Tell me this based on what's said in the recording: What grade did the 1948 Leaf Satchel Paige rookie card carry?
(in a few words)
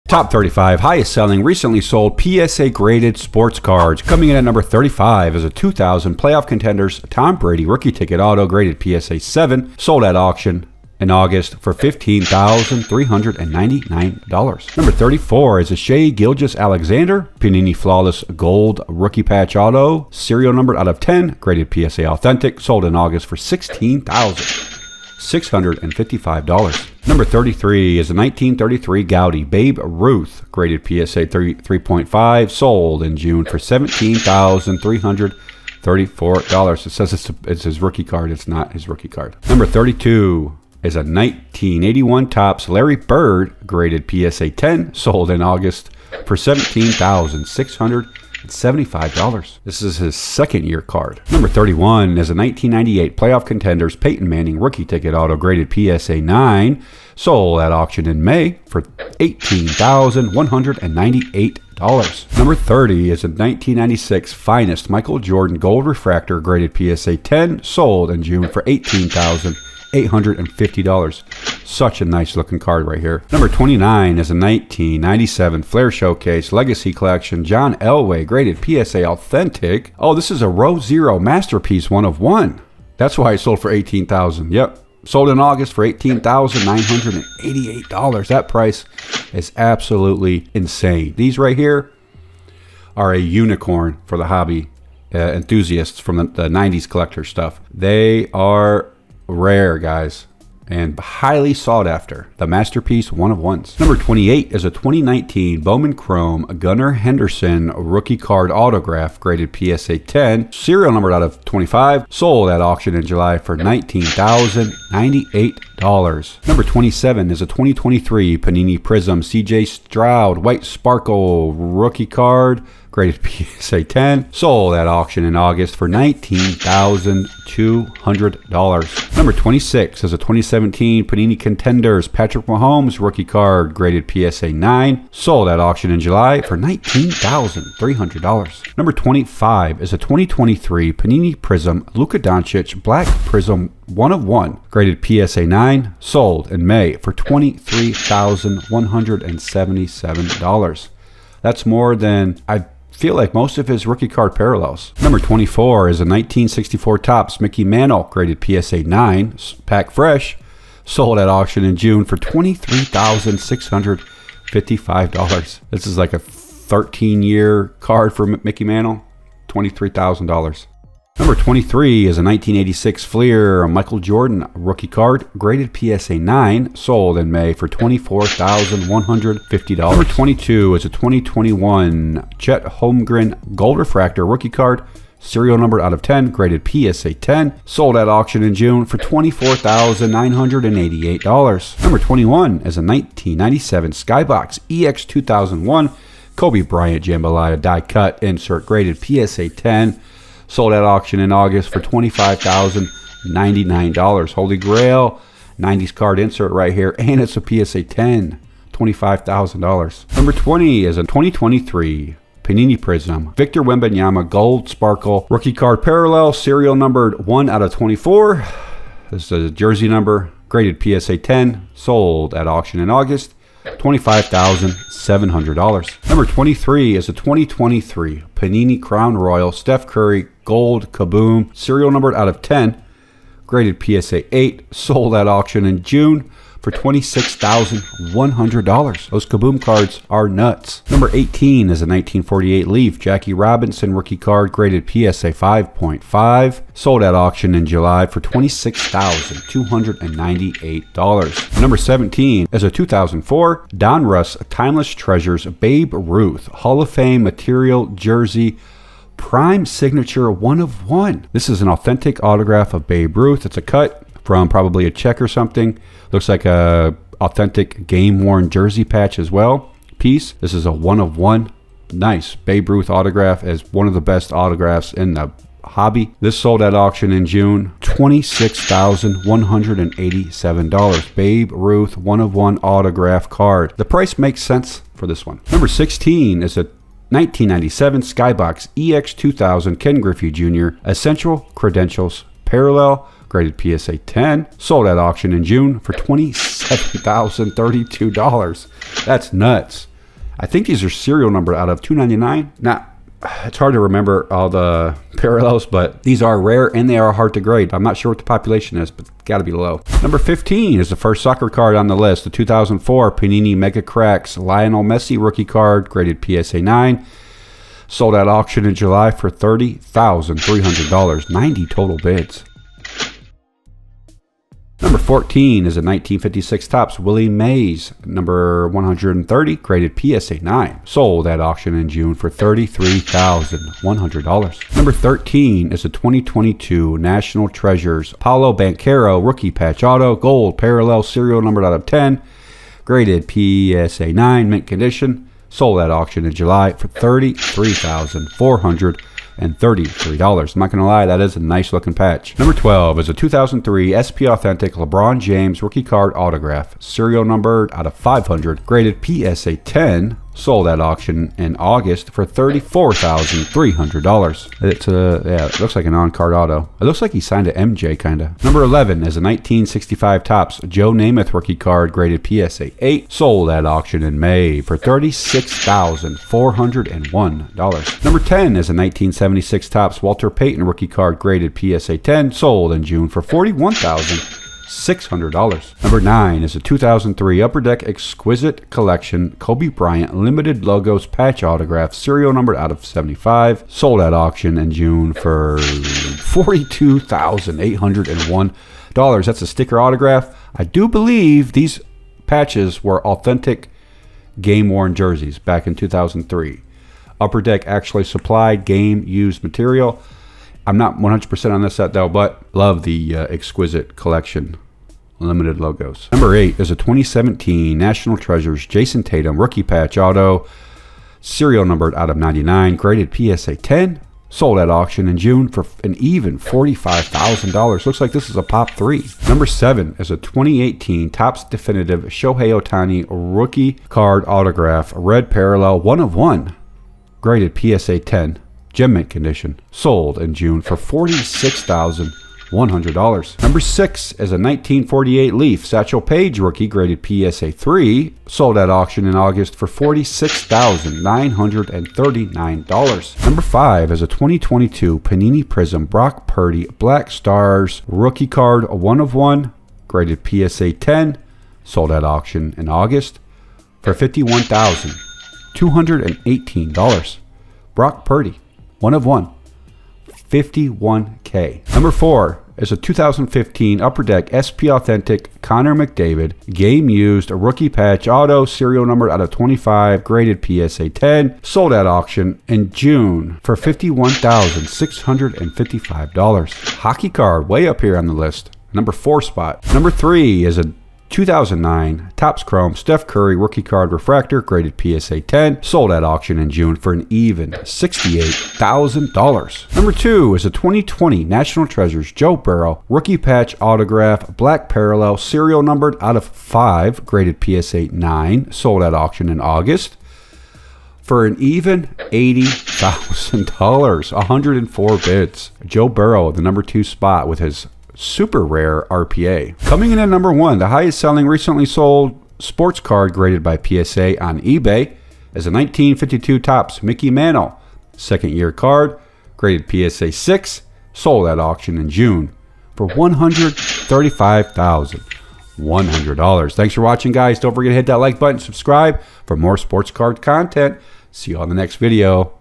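PSA 3.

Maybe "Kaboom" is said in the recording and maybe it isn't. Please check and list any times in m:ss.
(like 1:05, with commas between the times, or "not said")
3:50, 3:59.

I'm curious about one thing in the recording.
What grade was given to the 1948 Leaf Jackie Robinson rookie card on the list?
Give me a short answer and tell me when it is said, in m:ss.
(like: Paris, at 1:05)
PSA 5.5, at 4:04.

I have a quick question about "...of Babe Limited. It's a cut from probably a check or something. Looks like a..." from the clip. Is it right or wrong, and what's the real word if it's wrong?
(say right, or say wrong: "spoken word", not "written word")
wrong: "Ruth", not "Limited".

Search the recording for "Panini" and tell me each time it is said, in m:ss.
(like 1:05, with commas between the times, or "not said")
0:17, 1:58, 2:11, 2:20, 3:32, 3:48, 5:13, 7:34.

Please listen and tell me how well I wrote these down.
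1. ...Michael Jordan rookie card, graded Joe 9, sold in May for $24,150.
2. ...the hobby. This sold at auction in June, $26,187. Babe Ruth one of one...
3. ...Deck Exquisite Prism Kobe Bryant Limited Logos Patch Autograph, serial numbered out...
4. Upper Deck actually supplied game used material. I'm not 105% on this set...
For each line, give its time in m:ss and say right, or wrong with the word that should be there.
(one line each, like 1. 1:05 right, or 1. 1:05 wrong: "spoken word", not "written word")
1. 2:53 wrong: "PSA", not "Joe"
2. 4:35 right
3. 6:27 wrong: "Collection", not "Prism"
4. 6:47 wrong: "100", not "105".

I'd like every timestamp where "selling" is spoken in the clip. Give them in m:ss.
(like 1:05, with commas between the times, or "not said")
0:01, 8:40.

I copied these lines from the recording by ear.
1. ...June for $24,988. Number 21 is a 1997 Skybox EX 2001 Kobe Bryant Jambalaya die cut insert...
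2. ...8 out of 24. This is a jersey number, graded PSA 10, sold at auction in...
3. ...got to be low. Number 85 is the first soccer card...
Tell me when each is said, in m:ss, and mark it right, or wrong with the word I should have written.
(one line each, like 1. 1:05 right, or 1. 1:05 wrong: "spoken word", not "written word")
1. 3:08 right
2. 3:37 wrong: "1", not "8"
3. 5:09 wrong: "15", not "85".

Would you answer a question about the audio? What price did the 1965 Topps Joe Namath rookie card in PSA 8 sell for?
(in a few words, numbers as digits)
$36,401.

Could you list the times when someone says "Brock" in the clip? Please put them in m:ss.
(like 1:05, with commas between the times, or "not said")
7:35, 7:47.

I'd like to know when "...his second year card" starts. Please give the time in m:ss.
0:49.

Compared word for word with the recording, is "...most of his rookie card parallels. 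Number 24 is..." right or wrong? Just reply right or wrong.
right.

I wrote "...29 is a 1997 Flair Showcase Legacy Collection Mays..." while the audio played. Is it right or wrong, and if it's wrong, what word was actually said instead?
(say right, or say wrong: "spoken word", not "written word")
wrong: "John", not "Mays".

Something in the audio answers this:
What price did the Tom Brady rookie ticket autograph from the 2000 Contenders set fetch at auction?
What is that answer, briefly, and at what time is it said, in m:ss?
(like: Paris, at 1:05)
$15,399, at 0:11.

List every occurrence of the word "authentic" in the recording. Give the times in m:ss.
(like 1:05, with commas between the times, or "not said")
0:22, 1:19, 4:21, 4:27, 5:54, 6:43, 7:54.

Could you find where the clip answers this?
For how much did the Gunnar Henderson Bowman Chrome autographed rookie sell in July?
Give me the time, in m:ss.
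1:53.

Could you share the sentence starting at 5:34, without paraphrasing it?
Number 13 is a 2022 National Treasures Paolo Banchero Rookie Patch Auto Gold Parallel Serial Numbered Out of 10.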